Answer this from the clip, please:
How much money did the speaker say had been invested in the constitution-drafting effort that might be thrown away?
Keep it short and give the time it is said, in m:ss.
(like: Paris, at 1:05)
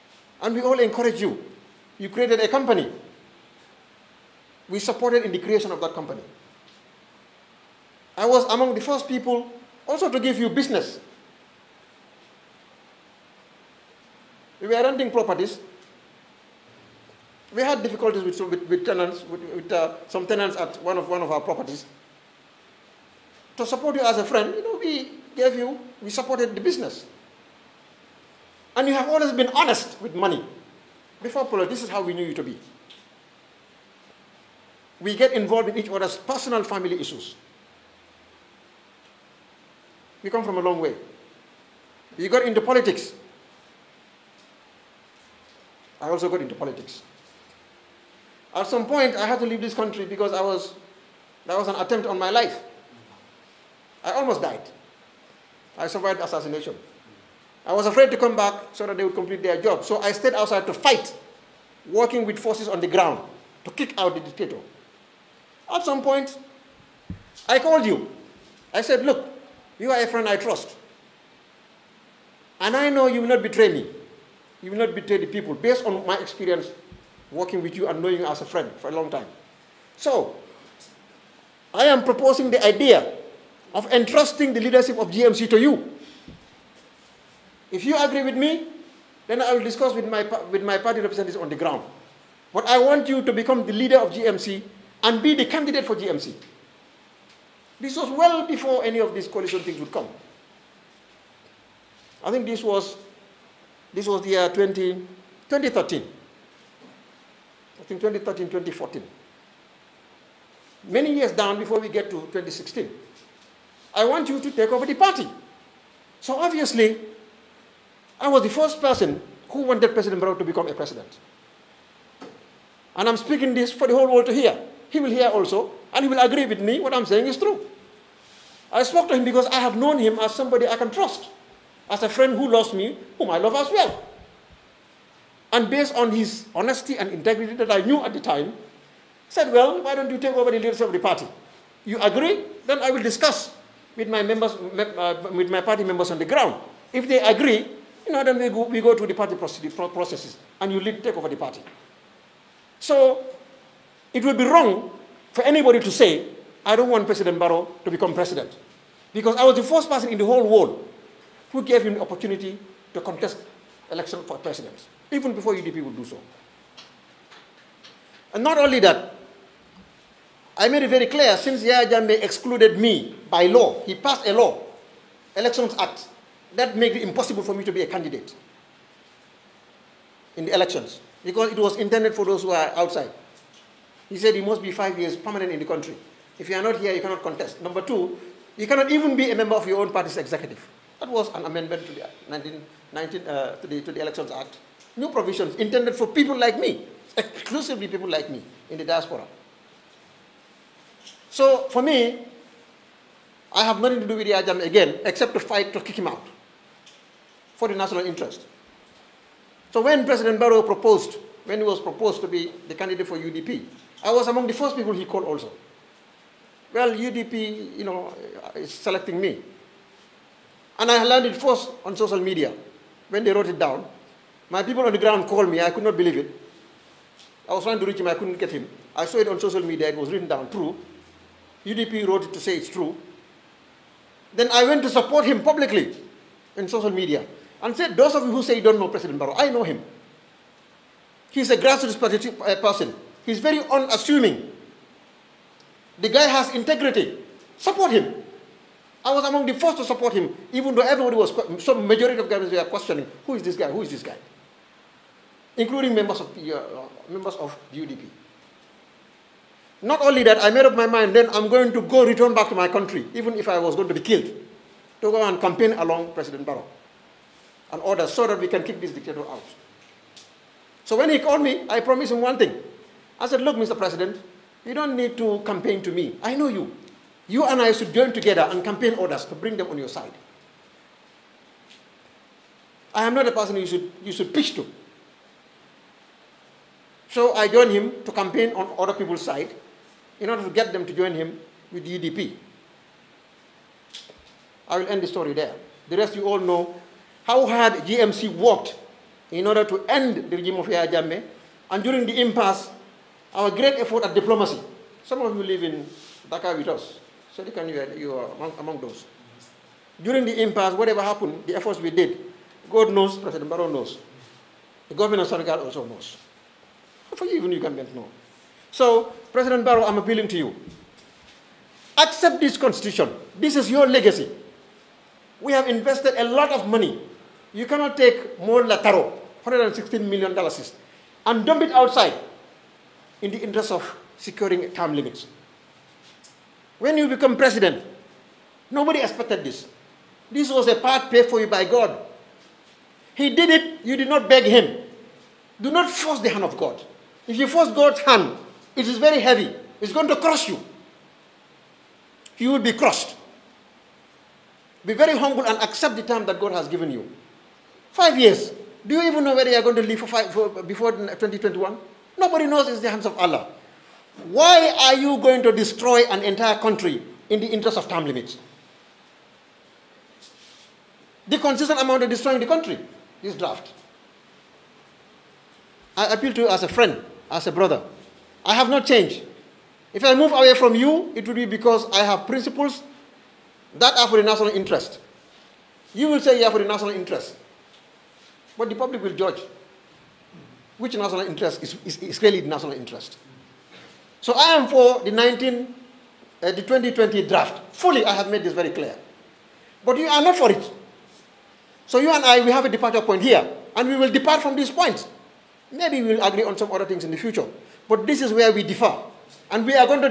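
$116 million, at 5:29.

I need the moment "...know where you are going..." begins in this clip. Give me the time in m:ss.
5:59.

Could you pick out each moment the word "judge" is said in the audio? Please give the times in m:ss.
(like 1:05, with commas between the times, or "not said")
6:29.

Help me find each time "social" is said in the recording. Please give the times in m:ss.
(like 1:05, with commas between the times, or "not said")
3:41, 3:49, 3:56.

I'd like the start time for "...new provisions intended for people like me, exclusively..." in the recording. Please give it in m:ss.
3:14.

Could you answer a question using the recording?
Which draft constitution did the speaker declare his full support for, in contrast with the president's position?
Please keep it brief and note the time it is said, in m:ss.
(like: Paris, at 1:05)
2020 draft, at 6:36.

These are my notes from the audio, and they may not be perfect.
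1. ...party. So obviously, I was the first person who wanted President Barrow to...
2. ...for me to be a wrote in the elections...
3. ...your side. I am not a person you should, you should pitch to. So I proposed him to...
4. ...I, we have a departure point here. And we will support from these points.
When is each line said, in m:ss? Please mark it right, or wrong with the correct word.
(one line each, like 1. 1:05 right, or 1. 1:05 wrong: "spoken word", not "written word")
1. 1:54 right
2. 2:57 wrong: "candidate", not "wrote"
3. 4:39 wrong: "joined", not "proposed"
4. 6:42 wrong: "depart", not "support".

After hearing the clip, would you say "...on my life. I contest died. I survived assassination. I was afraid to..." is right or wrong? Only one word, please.
wrong.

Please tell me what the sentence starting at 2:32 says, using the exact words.
So it would be wrong for anybody to say, I don't want President Barrow to become president.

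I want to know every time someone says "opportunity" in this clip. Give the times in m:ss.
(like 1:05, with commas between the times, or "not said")
2:42.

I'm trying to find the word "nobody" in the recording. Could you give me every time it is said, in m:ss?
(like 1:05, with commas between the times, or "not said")
5:38, 6:02.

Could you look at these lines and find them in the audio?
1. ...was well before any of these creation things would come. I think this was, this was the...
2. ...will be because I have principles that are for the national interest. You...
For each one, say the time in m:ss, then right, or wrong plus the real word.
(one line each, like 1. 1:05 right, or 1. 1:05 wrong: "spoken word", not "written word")
1. 1:37 wrong: "coalition", not "creation"
2. 6:21 right.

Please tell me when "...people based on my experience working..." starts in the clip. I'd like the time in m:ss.
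1:15.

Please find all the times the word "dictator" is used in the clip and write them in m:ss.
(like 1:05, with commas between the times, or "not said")
1:04, 4:28.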